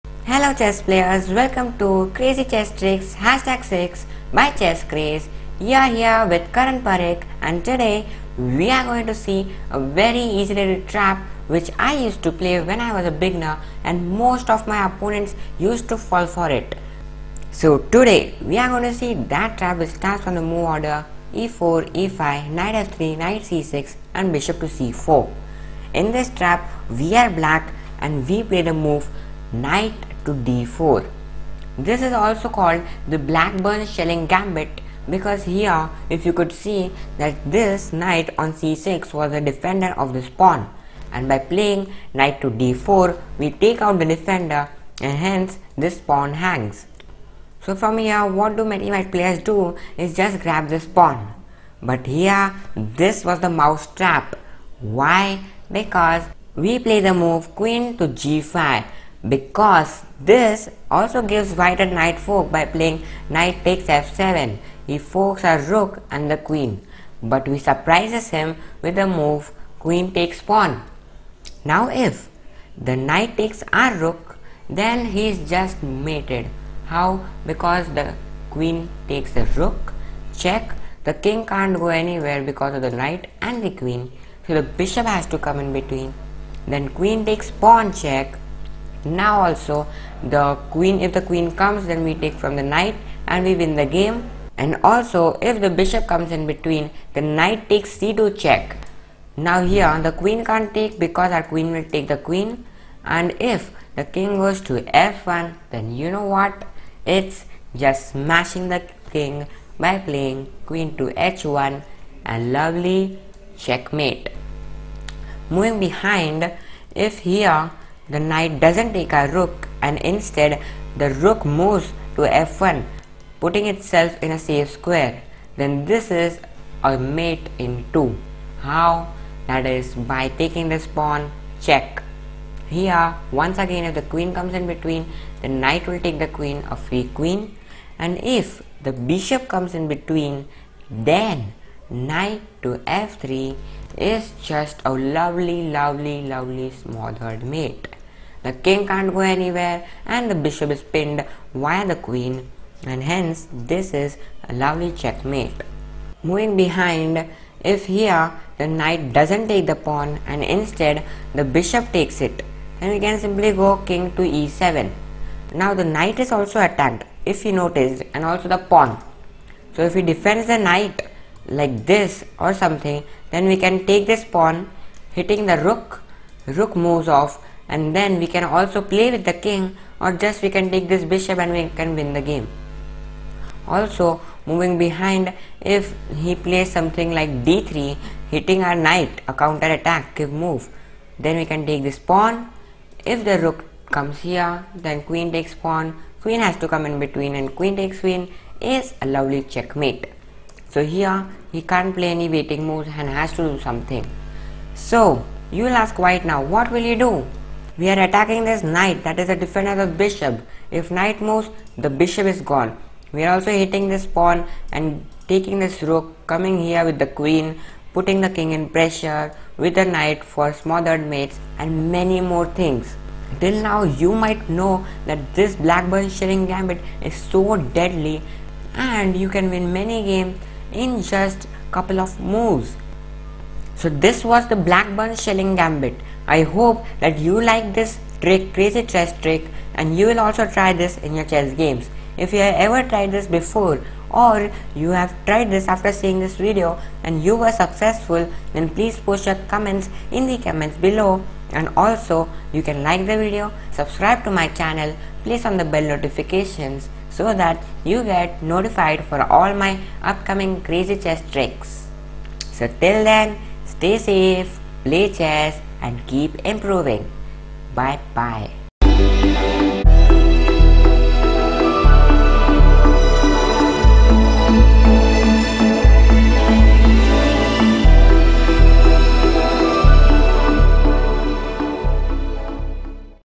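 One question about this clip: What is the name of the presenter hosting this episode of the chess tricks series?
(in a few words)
Karan Parikh.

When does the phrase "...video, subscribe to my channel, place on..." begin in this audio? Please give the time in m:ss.
4:13.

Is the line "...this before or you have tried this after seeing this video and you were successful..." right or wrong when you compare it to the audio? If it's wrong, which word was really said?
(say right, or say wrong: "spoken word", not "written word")
right.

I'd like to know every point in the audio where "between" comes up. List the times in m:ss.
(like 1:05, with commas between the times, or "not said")
1:25, 1:36, 2:14, 2:19, 3:16.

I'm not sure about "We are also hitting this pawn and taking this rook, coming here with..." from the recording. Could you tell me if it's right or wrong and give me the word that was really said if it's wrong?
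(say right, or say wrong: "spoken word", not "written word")
right.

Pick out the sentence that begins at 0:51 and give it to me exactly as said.
But here this was the mouse trap.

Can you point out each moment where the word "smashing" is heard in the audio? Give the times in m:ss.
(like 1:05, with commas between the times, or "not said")
1:48.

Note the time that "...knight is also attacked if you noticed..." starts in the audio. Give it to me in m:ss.
2:45.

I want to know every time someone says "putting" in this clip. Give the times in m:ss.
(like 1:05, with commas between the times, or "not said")
2:03, 3:37.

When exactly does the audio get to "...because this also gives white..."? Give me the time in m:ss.
0:59.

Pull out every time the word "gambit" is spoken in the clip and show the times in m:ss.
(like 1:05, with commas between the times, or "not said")
0:34, 3:46, 3:55.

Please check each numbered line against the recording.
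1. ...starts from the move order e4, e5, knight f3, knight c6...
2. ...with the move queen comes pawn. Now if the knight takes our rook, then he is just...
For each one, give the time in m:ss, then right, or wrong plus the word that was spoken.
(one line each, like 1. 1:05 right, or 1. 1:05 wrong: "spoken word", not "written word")
1. 0:19 right
2. 1:08 wrong: "takes", not "comes".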